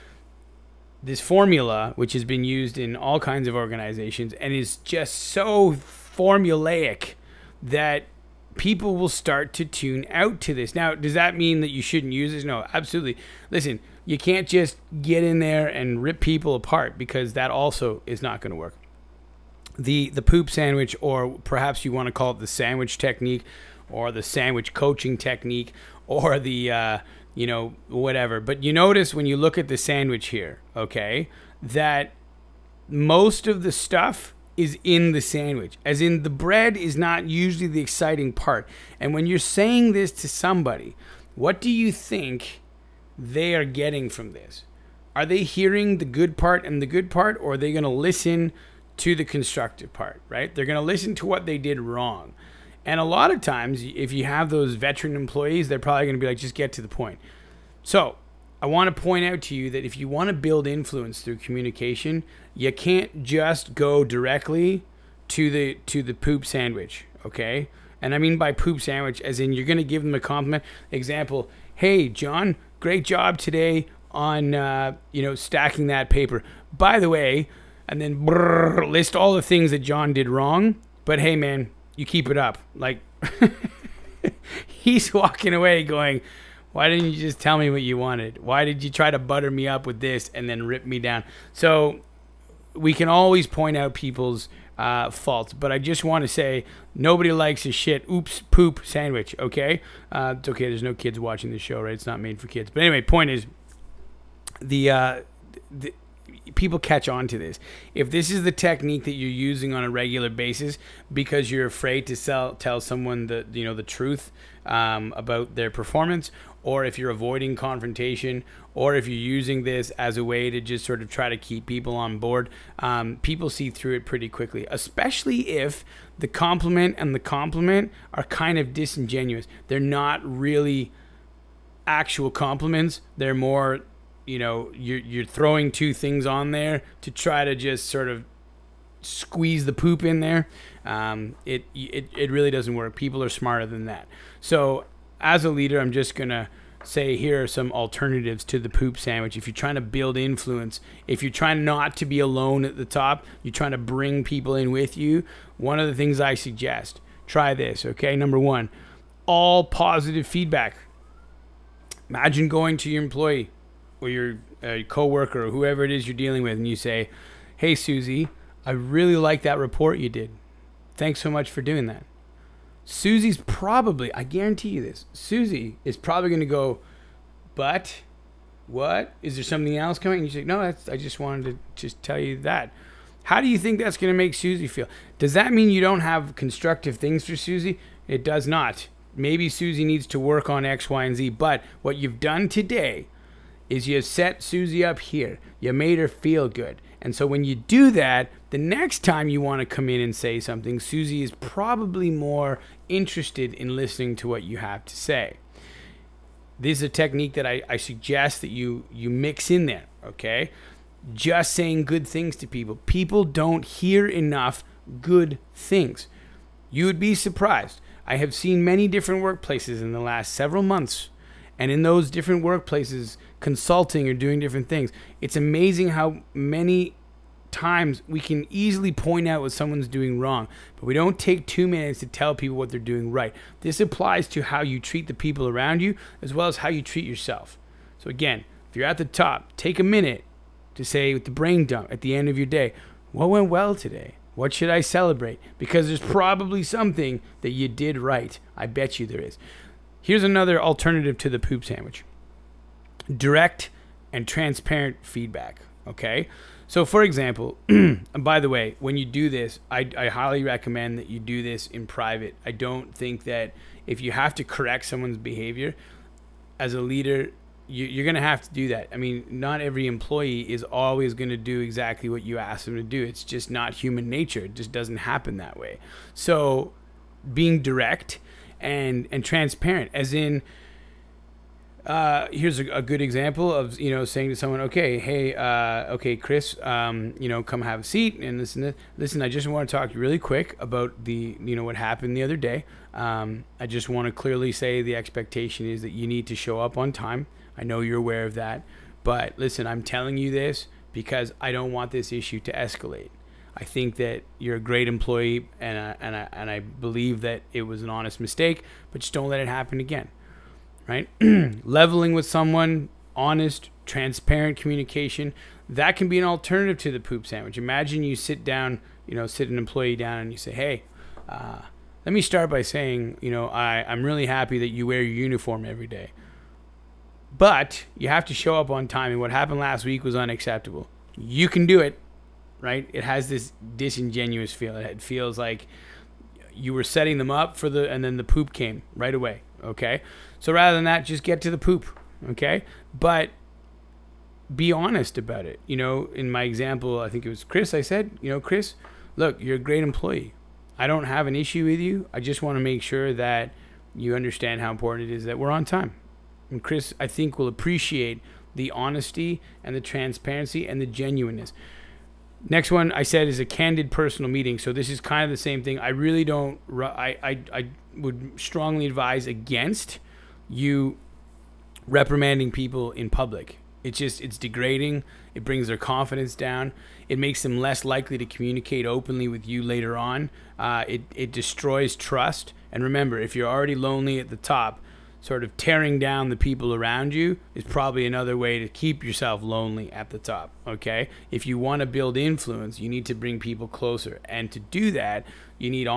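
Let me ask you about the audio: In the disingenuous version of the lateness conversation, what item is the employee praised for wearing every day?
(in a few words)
uniform.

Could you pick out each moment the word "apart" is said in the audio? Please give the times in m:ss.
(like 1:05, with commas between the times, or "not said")
0:16.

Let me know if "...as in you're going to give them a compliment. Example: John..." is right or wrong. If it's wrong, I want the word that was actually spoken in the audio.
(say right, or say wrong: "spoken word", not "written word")
wrong: "Hey", not "John".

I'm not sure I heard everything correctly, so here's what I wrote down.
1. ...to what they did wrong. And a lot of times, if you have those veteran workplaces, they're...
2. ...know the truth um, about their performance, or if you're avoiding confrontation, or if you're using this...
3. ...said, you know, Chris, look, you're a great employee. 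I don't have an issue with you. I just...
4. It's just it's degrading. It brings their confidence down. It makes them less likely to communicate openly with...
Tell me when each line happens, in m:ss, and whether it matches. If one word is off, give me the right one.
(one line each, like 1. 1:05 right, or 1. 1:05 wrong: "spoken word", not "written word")
1. 0:51 wrong: "employees", not "workplaces"
2. 1:53 right
3. 5:47 right
4. 6:13 right.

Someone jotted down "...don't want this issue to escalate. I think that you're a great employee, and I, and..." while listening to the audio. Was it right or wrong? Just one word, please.
right.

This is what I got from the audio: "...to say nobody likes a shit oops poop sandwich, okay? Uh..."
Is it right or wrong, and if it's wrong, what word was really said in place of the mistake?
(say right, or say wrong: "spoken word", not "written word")
right.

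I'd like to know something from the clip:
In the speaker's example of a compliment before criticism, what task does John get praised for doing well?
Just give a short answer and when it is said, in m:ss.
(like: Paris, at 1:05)
stacking that paper, at 1:15.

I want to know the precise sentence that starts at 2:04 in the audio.
Especially if the compliment and the compliment are kind of disingenuous.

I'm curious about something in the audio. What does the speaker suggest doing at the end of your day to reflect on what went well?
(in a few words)
brain dump.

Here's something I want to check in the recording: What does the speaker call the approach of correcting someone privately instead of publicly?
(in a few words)
candid personal meeting.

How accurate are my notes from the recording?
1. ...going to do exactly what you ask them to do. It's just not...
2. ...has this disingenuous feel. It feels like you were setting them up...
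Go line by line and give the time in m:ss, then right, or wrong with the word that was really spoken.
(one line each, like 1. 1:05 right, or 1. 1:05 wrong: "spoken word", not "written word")
1. 4:31 right
2. 5:33 right.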